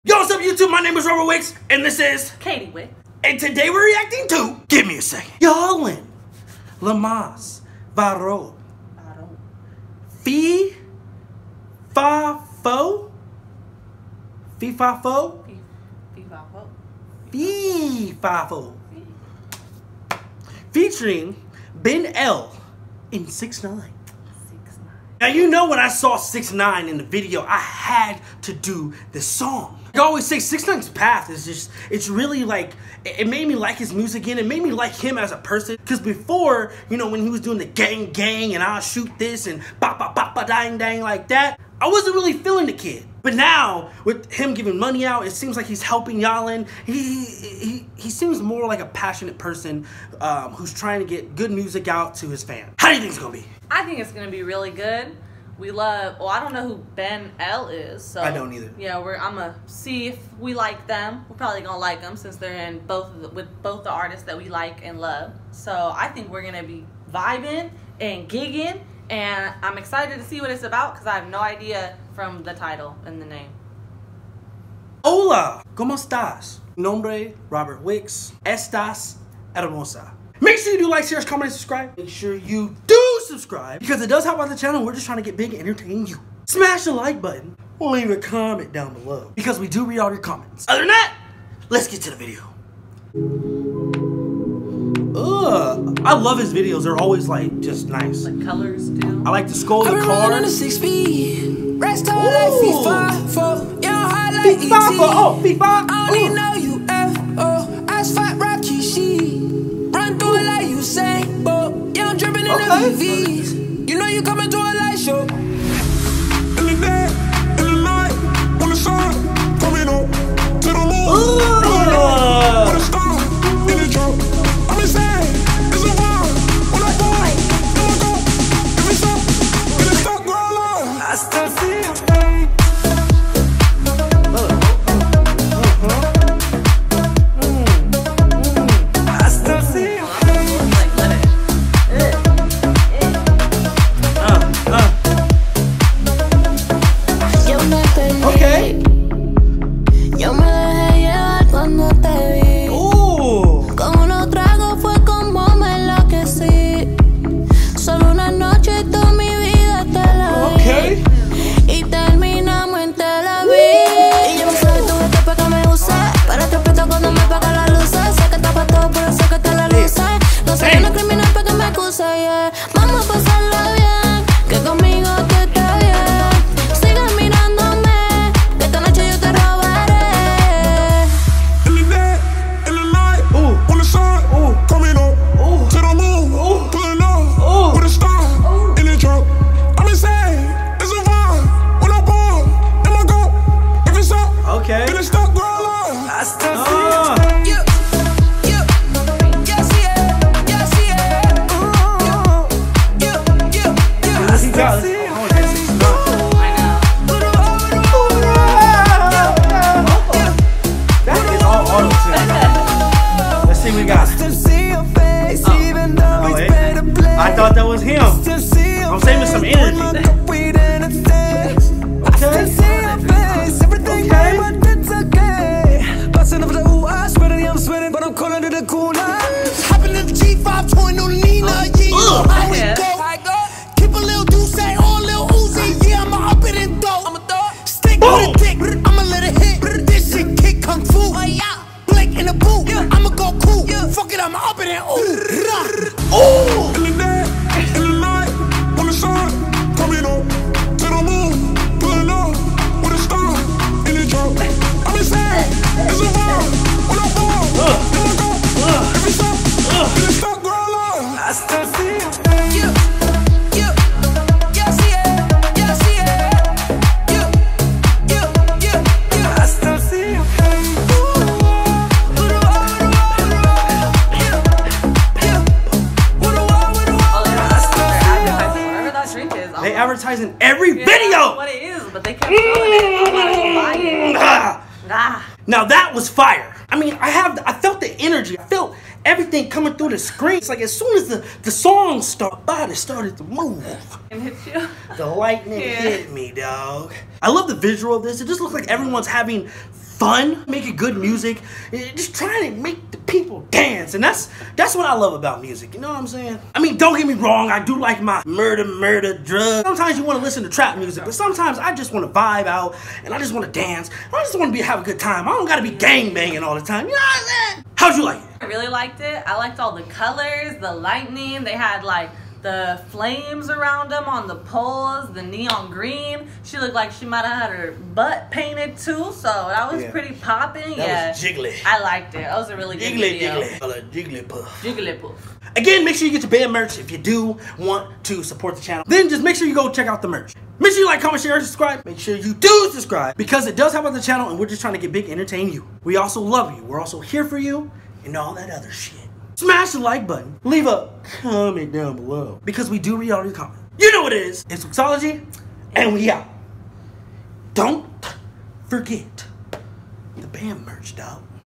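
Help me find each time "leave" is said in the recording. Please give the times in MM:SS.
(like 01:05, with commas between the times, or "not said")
01:27, 05:50.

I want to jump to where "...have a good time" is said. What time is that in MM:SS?
05:14.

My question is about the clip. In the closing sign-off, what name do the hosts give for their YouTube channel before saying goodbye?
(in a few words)
Wicksology.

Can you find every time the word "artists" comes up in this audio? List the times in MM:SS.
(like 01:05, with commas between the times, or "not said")
01:03.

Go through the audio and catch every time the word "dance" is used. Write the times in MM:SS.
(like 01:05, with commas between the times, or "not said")
05:03, 05:13.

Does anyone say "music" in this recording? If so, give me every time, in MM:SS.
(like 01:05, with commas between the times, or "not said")
00:33, 00:51, 05:00, 05:05, 05:10.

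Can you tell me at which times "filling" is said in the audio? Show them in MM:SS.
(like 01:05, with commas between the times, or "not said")
not said.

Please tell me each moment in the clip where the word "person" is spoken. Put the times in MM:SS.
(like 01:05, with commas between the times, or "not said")
00:35, 00:49.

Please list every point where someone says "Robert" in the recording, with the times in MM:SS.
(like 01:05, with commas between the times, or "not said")
00:01, 01:17.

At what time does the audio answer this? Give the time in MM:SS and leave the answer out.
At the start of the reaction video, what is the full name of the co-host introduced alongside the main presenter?
00:02.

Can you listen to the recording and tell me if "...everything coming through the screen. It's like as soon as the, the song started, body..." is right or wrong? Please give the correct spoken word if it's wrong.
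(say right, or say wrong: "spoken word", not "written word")
right.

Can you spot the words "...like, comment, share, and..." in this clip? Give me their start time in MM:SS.
05:40.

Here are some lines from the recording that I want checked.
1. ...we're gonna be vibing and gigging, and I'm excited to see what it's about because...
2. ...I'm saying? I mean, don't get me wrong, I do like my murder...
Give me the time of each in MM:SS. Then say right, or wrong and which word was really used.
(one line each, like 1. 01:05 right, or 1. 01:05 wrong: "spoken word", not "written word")
1. 01:06 right
2. 05:05 right.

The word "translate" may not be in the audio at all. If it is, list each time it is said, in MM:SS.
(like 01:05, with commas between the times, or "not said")
not said.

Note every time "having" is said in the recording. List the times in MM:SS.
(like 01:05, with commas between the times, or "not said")
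04:59.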